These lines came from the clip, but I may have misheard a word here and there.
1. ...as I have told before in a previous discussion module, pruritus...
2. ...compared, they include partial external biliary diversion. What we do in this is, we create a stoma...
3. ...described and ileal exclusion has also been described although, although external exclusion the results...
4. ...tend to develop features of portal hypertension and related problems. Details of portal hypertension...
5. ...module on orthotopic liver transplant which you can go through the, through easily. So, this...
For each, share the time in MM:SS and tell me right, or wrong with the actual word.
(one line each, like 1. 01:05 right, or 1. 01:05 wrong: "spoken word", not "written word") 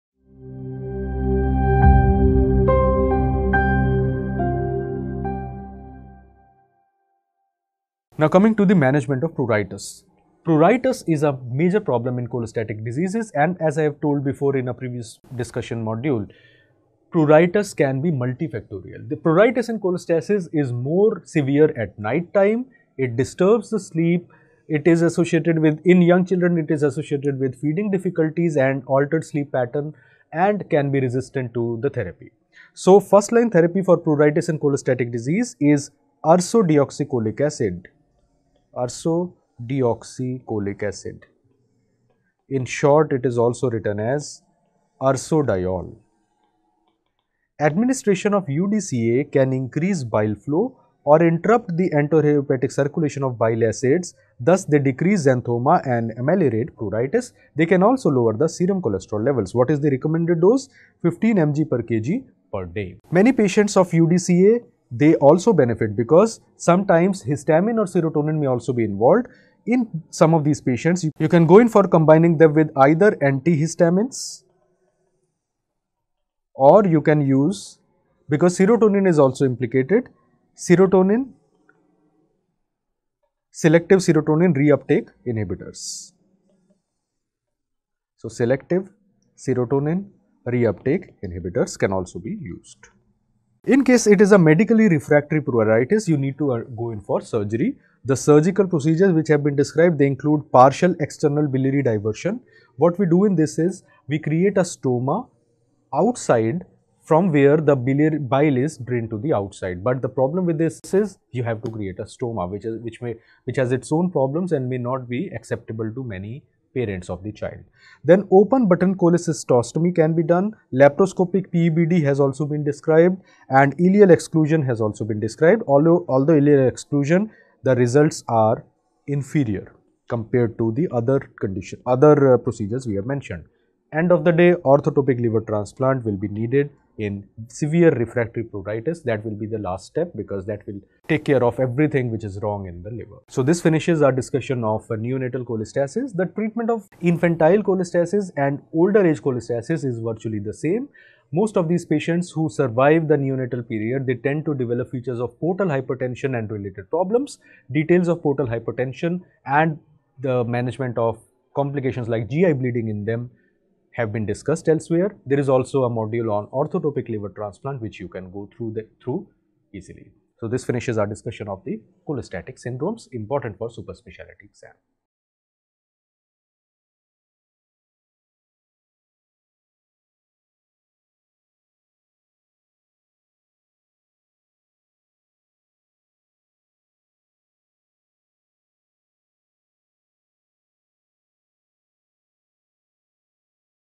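1. 00:13 right
2. 01:39 wrong: "described", not "compared"
3. 02:02 wrong: "ileal", not "external"
4. 02:34 right
5. 02:45 right.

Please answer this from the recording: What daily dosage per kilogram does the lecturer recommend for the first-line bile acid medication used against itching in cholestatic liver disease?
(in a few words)
15 mg per kg per day.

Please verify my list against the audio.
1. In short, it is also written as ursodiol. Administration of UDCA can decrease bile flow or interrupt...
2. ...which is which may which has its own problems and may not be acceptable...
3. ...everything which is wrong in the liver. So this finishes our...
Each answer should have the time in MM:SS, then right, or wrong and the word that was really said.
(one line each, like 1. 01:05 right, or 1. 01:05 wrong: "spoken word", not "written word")
1. 00:42 wrong: "increase", not "decrease"
2. 01:52 right
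3. 02:21 right.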